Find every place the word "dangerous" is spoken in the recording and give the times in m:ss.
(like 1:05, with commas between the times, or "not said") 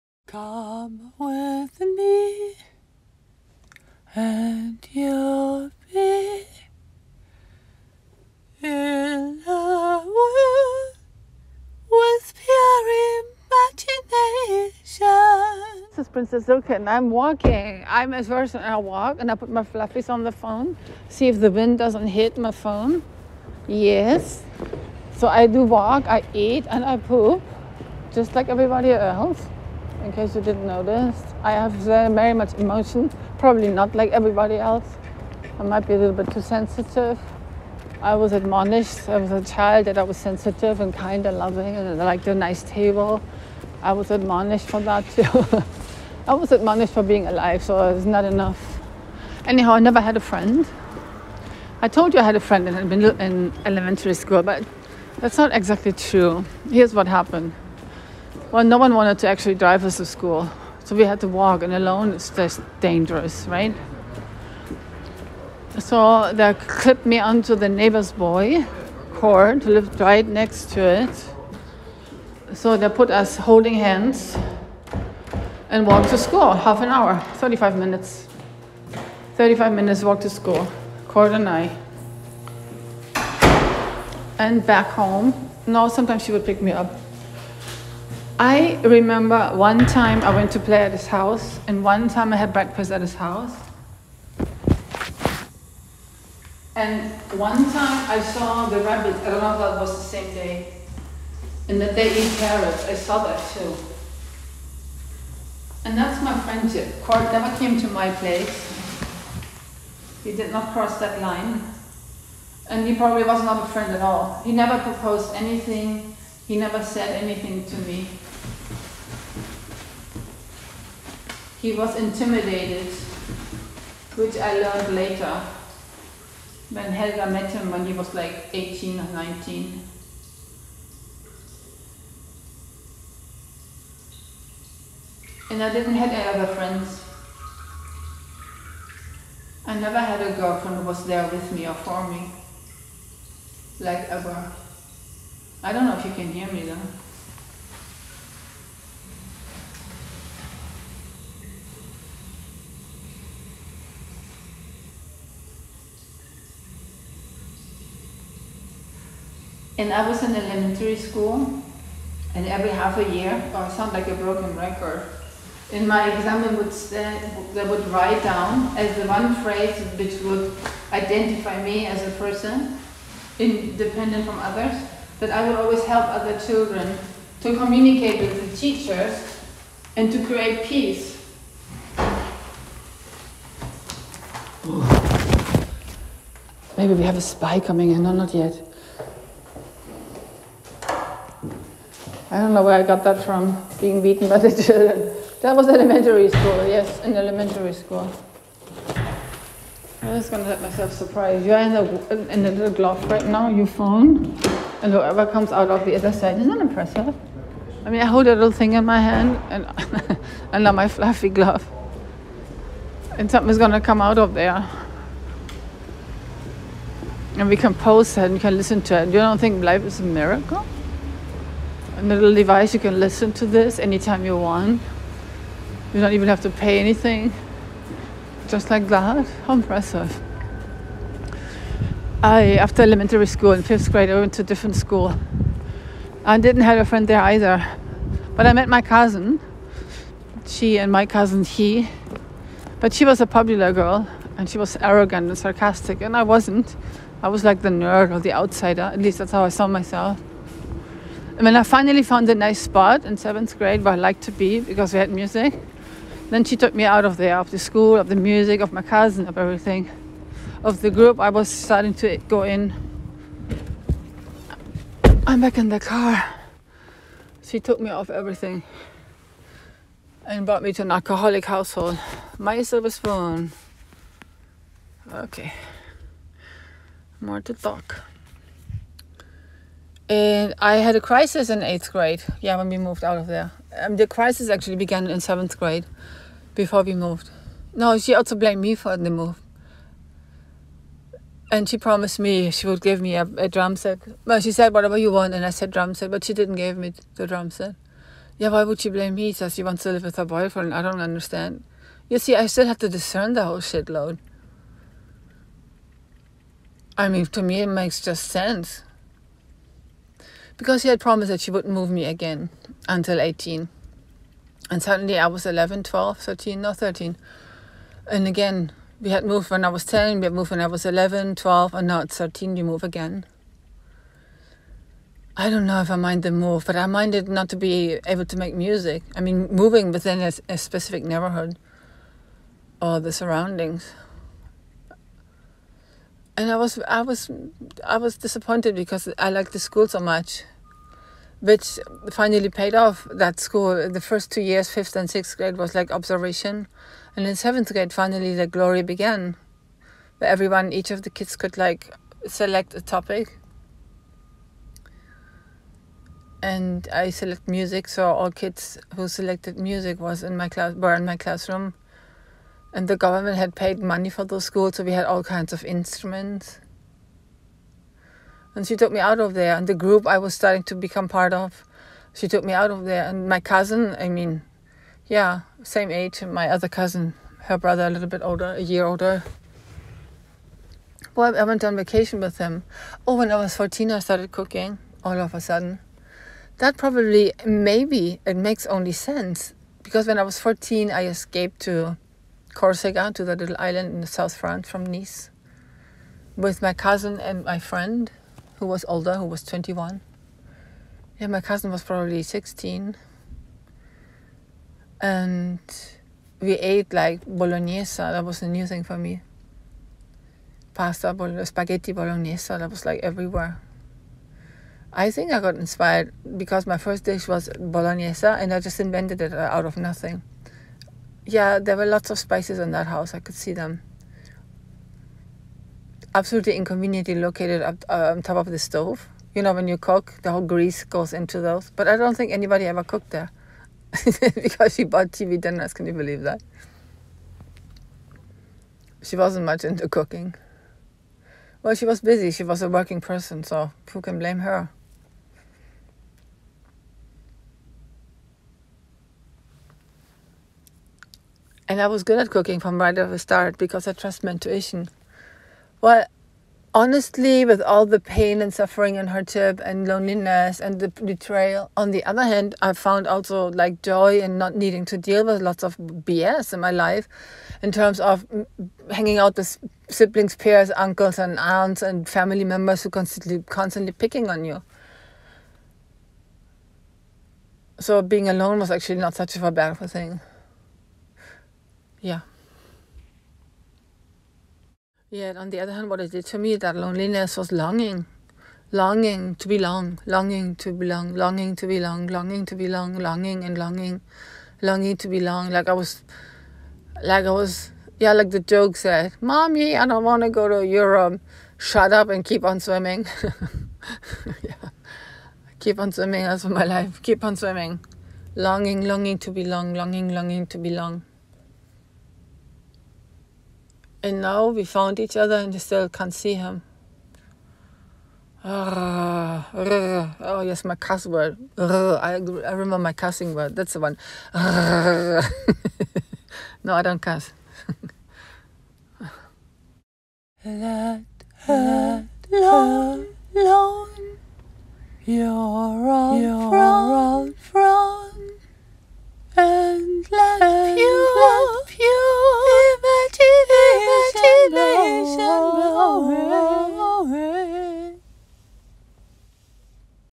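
1:02.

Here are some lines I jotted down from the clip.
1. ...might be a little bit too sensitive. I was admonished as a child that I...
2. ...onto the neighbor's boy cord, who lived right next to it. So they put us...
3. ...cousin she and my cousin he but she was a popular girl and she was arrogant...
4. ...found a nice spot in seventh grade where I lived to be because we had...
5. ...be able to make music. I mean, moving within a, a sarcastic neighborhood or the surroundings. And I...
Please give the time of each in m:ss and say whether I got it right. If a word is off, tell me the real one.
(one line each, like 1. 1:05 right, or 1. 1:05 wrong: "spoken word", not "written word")
1. 0:35 right
2. 1:07 right
3. 3:58 right
4. 4:12 wrong: "liked", not "lived"
5. 5:27 wrong: "specific", not "sarcastic".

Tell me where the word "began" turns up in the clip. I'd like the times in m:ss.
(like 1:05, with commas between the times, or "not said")
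4:44, 5:48.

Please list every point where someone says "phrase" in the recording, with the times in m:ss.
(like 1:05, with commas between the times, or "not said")
2:49.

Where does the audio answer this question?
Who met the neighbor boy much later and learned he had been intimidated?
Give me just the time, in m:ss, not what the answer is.
2:06.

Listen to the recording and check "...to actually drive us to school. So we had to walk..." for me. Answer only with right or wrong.
right.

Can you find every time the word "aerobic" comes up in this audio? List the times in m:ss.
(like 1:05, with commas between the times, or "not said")
not said.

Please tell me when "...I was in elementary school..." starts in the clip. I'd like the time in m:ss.
2:39.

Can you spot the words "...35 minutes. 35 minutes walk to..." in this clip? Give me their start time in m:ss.
1:17.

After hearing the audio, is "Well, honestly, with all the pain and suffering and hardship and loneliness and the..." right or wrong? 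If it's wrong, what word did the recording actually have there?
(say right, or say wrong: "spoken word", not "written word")
right.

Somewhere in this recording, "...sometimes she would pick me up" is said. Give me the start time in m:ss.
1:25.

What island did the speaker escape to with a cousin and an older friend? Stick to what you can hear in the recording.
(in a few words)
Corsica.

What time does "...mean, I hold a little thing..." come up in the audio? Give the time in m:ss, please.
3:27.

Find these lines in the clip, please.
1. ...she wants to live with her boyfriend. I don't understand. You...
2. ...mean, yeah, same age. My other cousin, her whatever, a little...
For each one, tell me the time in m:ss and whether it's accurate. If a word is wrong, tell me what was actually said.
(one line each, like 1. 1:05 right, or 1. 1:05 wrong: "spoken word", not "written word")
1. 4:59 right
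2. 6:14 wrong: "brother", not "whatever".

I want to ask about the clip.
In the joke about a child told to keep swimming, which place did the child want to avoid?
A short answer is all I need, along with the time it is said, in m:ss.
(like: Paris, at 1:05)
Europe, at 8:20.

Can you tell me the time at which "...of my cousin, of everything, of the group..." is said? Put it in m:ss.
4:18.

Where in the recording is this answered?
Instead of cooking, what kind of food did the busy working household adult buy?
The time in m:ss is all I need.
7:15.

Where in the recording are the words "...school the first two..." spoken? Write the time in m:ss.
5:43.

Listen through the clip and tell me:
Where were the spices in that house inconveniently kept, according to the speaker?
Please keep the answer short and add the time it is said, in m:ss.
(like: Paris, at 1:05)
on top of the stove, at 7:08.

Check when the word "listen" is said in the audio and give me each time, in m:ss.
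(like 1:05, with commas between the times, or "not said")
3:38, 3:42.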